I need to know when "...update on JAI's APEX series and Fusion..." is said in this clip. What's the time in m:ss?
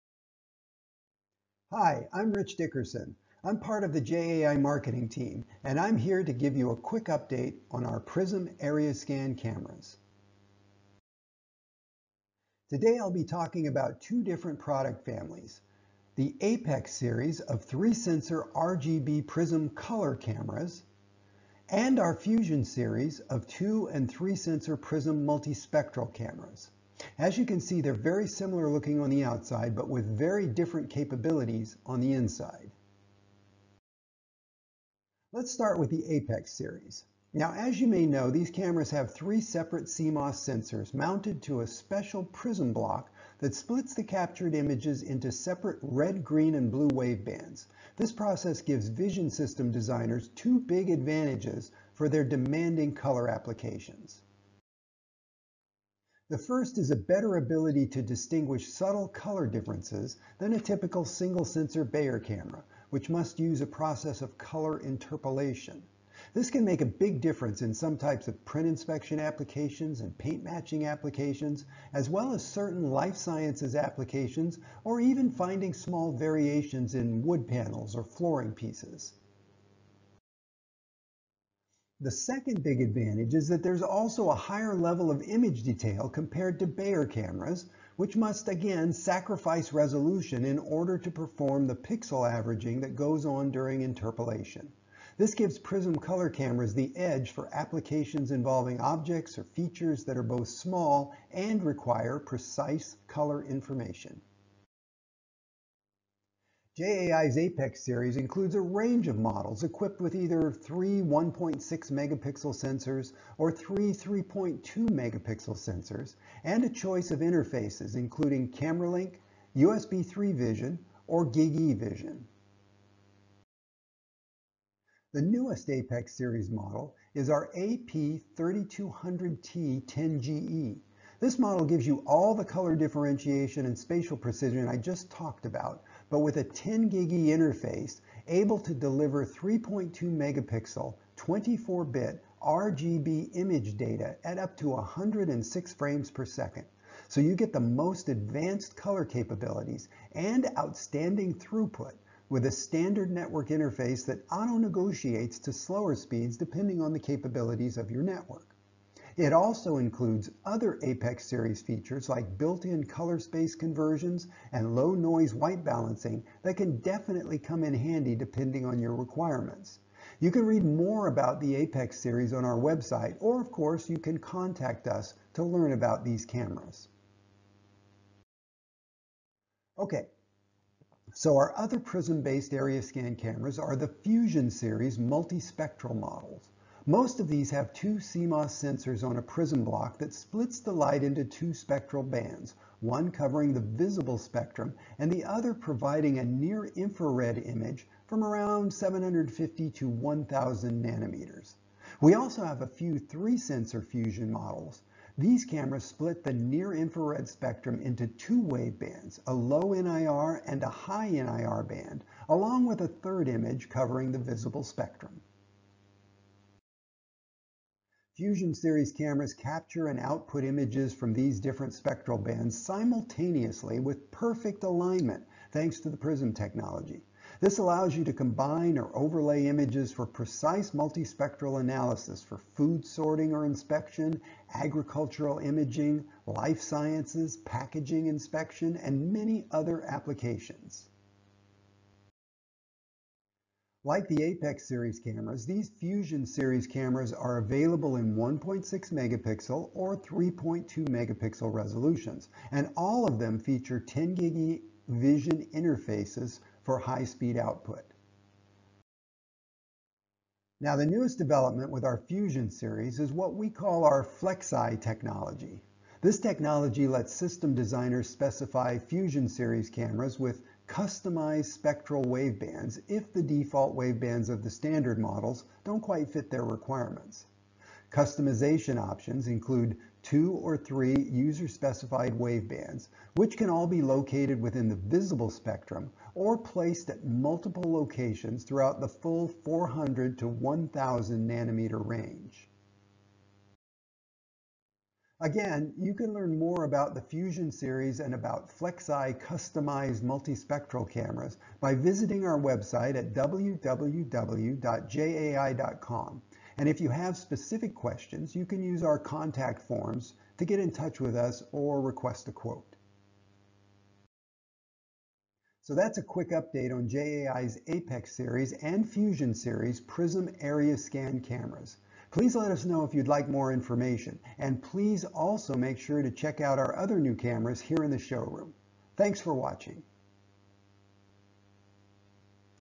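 5:16.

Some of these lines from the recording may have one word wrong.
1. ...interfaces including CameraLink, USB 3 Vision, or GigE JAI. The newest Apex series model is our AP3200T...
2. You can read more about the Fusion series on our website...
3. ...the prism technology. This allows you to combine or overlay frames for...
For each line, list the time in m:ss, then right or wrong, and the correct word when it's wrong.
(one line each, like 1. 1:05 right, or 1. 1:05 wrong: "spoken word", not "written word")
1. 1:57 wrong: "Vision", not "JAI"
2. 2:50 wrong: "Apex", not "Fusion"
3. 3:45 wrong: "images", not "frames".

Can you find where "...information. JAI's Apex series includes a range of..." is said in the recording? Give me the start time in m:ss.
1:43.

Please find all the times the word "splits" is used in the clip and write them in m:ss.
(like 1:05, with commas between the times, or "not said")
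0:43, 3:10, 3:25.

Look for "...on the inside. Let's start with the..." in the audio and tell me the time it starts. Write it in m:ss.
0:31.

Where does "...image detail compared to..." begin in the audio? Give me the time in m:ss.
1:25.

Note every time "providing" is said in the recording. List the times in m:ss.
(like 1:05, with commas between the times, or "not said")
3:15.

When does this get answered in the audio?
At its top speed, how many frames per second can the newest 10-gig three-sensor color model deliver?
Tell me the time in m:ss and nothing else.
2:24.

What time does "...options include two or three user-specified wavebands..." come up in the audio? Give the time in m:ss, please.
4:38.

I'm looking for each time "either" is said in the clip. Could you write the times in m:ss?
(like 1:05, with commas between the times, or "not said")
1:50.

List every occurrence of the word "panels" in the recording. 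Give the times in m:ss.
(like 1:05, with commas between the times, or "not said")
1:17.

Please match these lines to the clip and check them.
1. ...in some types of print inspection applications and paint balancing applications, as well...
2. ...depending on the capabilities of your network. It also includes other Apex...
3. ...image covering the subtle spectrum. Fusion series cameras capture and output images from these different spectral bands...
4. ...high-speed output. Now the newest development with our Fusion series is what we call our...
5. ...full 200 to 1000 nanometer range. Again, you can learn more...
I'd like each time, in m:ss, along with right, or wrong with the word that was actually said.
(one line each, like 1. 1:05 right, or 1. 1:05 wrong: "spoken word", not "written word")
1. 1:07 wrong: "matching", not "balancing"
2. 2:36 right
3. 3:33 wrong: "visible", not "subtle"
4. 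4:16 right
5. 4:48 wrong: "400", not "200".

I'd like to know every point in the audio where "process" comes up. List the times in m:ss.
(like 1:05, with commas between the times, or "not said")
0:48, 1:03.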